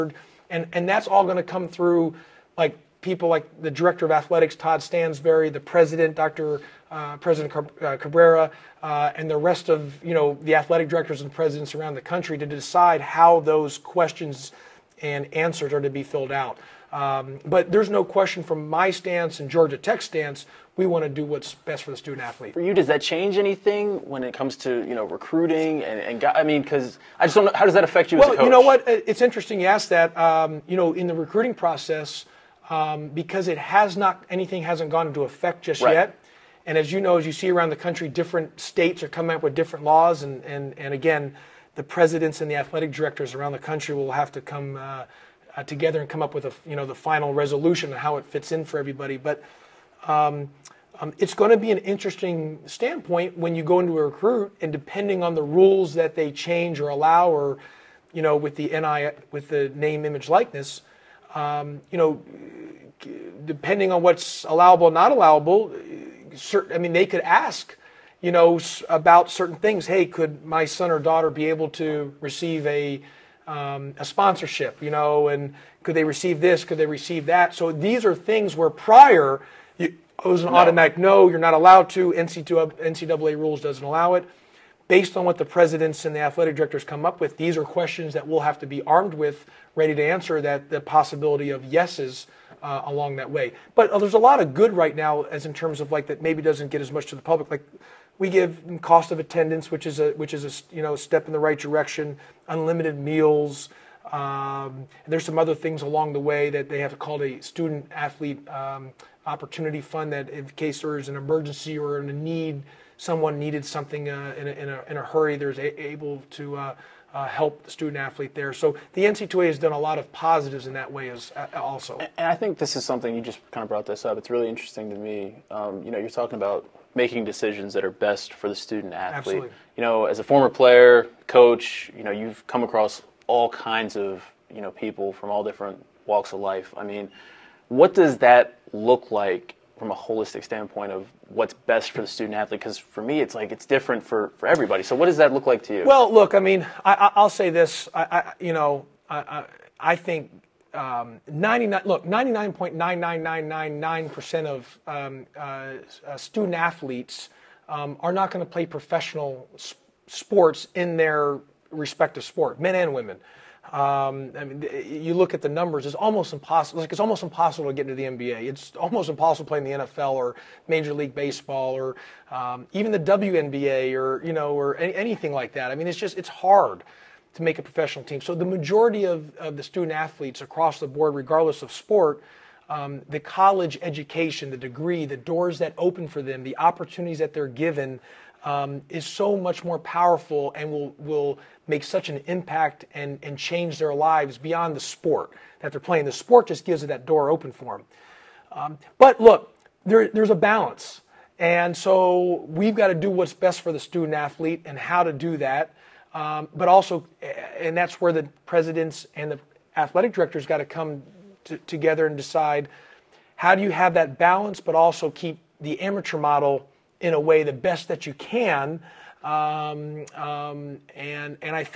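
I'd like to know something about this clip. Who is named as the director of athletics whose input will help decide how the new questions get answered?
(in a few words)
Todd Stansbury.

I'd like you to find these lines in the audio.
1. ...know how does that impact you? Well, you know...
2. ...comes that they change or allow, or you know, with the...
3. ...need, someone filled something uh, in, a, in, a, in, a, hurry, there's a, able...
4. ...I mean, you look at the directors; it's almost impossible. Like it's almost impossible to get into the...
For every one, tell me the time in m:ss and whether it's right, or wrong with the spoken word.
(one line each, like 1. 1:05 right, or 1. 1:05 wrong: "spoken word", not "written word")
1. 0:27 wrong: "affect", not "impact"
2. 0:55 wrong: "rules", not "comes"
3. 1:52 wrong: "needed", not "filled"
4. 2:44 wrong: "numbers", not "directors".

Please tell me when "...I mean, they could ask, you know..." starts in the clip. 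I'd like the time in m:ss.
1:06.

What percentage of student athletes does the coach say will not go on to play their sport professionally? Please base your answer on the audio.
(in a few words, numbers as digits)
99.99999 percent.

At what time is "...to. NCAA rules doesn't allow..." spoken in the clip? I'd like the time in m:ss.
1:21.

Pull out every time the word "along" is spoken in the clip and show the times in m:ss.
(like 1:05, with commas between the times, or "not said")
1:32, 1:45.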